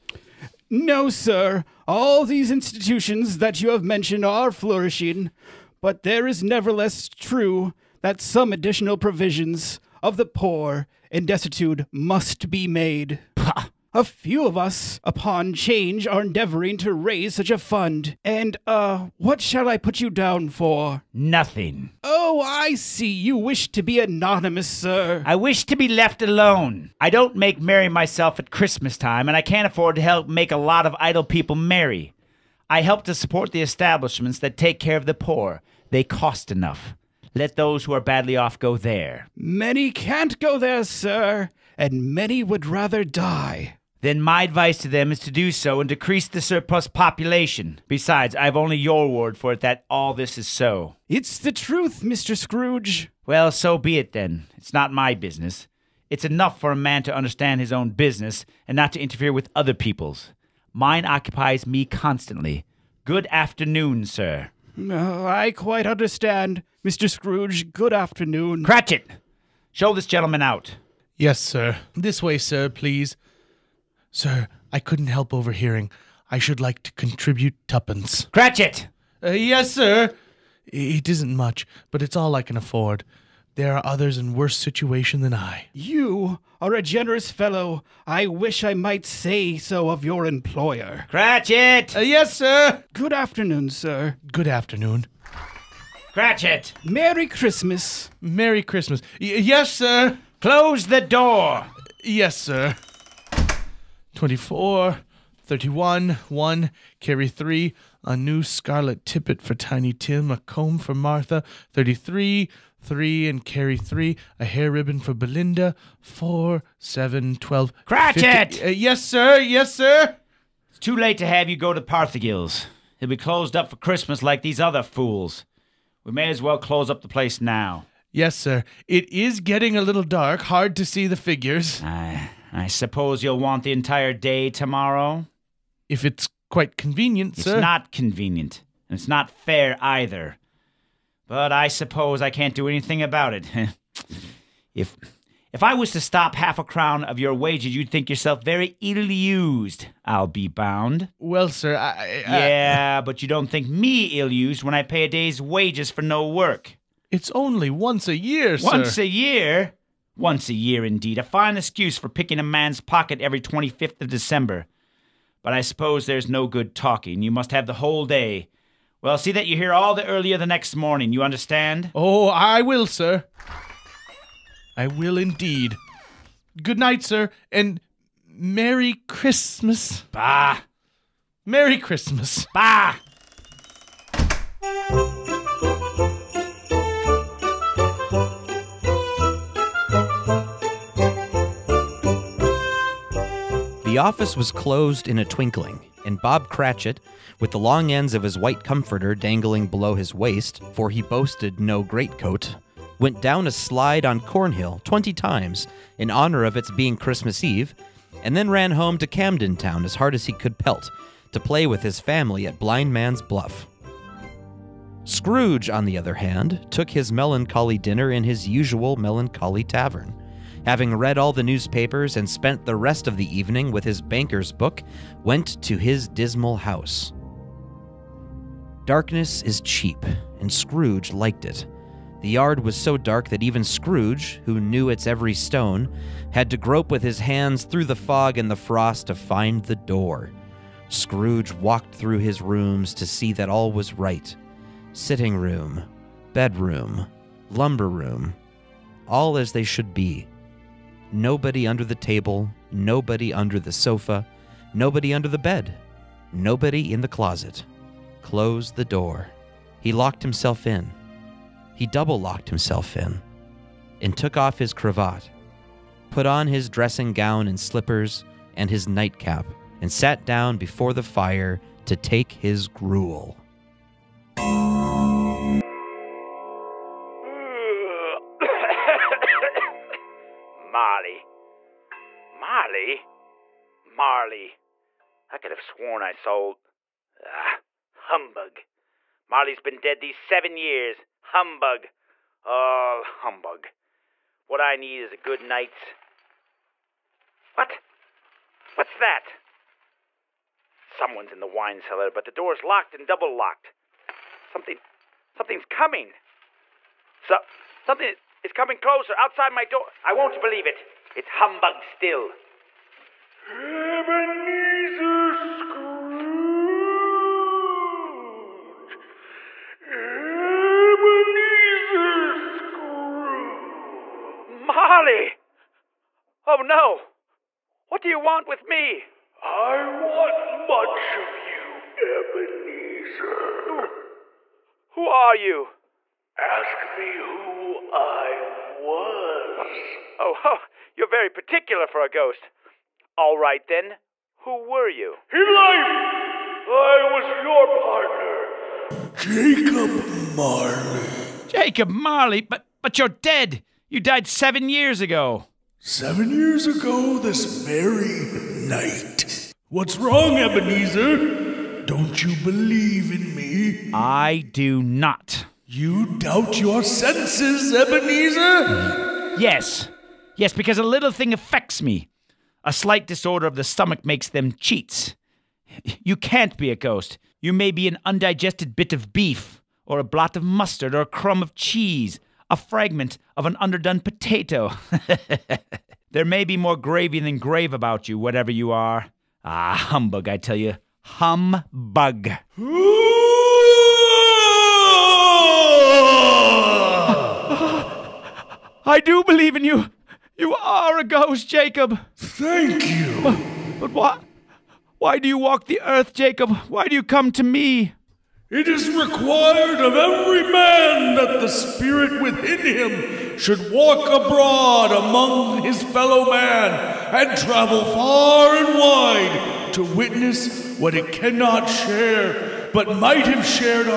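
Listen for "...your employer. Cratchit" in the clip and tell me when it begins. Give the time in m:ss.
1:30.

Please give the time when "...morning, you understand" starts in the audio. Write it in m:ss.
2:50.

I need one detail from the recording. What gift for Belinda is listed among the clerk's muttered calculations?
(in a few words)
A hair ribbon.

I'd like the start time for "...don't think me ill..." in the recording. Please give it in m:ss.
2:33.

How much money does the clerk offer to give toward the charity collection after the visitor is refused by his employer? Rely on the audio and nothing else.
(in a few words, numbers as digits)
Twopence.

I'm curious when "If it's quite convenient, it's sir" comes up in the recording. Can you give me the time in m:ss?
2:15.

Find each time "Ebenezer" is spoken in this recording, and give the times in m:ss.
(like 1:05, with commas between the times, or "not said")
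5:13, 5:19, 5:32, 6:00, 6:07.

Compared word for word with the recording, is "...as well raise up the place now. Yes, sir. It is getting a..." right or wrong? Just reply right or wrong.
wrong.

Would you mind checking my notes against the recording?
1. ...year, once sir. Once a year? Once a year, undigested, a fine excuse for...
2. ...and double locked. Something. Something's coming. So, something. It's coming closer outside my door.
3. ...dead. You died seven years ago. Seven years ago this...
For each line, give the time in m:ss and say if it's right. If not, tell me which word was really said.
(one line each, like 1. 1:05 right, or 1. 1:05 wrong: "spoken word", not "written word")
1. 2:38 wrong: "indeed", not "undigested"
2. 5:02 right
3. 5:53 right.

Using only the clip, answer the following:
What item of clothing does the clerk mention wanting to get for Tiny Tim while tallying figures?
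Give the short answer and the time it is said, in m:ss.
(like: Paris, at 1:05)
A new scarlet tippet, at 1:48.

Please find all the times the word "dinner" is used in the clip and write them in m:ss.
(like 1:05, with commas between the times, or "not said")
3:37.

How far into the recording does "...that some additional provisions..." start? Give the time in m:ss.
0:08.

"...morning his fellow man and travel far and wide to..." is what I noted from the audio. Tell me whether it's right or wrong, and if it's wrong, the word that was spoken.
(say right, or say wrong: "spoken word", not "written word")
wrong: "among", not "morning".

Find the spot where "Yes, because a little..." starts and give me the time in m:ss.
6:10.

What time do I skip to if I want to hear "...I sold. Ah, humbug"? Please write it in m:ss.
4:46.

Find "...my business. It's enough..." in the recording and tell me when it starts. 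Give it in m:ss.
0:54.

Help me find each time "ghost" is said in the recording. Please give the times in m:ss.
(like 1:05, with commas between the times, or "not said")
5:42, 6:16, 6:41.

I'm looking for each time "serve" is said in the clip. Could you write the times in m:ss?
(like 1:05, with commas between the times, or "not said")
not said.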